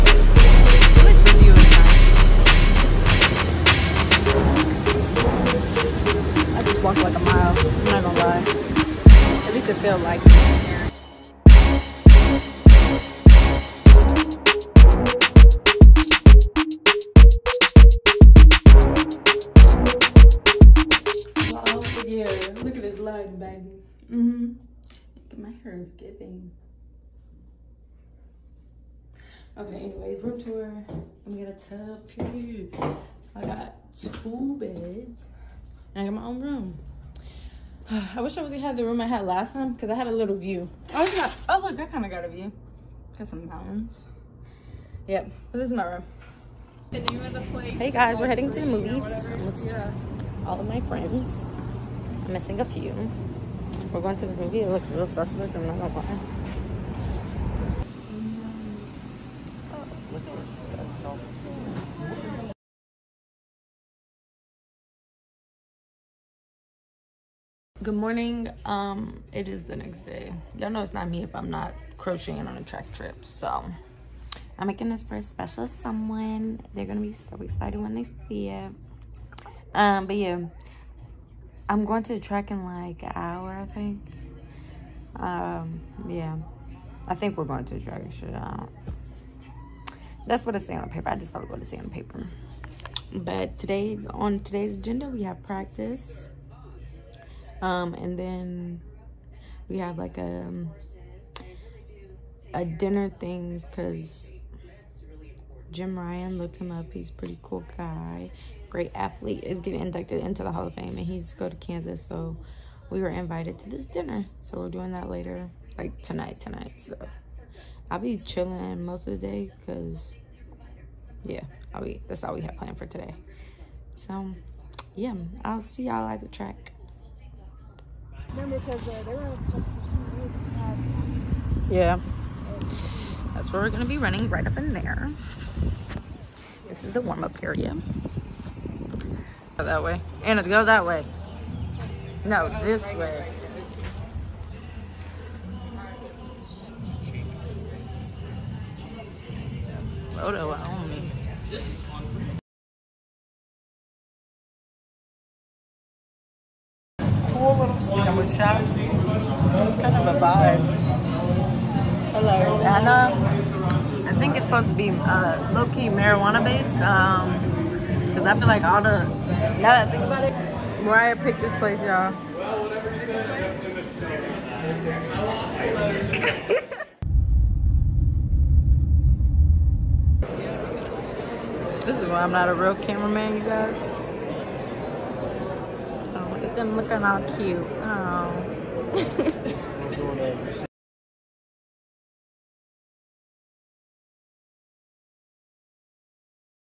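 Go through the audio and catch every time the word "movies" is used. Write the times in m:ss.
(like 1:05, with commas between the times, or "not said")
0:48, 0:54.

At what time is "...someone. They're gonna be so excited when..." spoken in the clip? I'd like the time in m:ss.
1:15.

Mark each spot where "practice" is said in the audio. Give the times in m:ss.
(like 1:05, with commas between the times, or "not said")
1:35.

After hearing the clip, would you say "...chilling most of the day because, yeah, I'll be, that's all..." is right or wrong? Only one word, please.
right.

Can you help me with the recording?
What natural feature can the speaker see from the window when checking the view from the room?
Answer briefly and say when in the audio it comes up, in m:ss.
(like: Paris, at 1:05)
Mountains, at 0:43.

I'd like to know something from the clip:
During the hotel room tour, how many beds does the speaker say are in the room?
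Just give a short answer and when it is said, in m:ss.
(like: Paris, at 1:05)
2, at 0:33.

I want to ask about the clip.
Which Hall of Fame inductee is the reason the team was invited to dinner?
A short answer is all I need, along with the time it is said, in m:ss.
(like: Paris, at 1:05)
Jim Ryun, at 1:45.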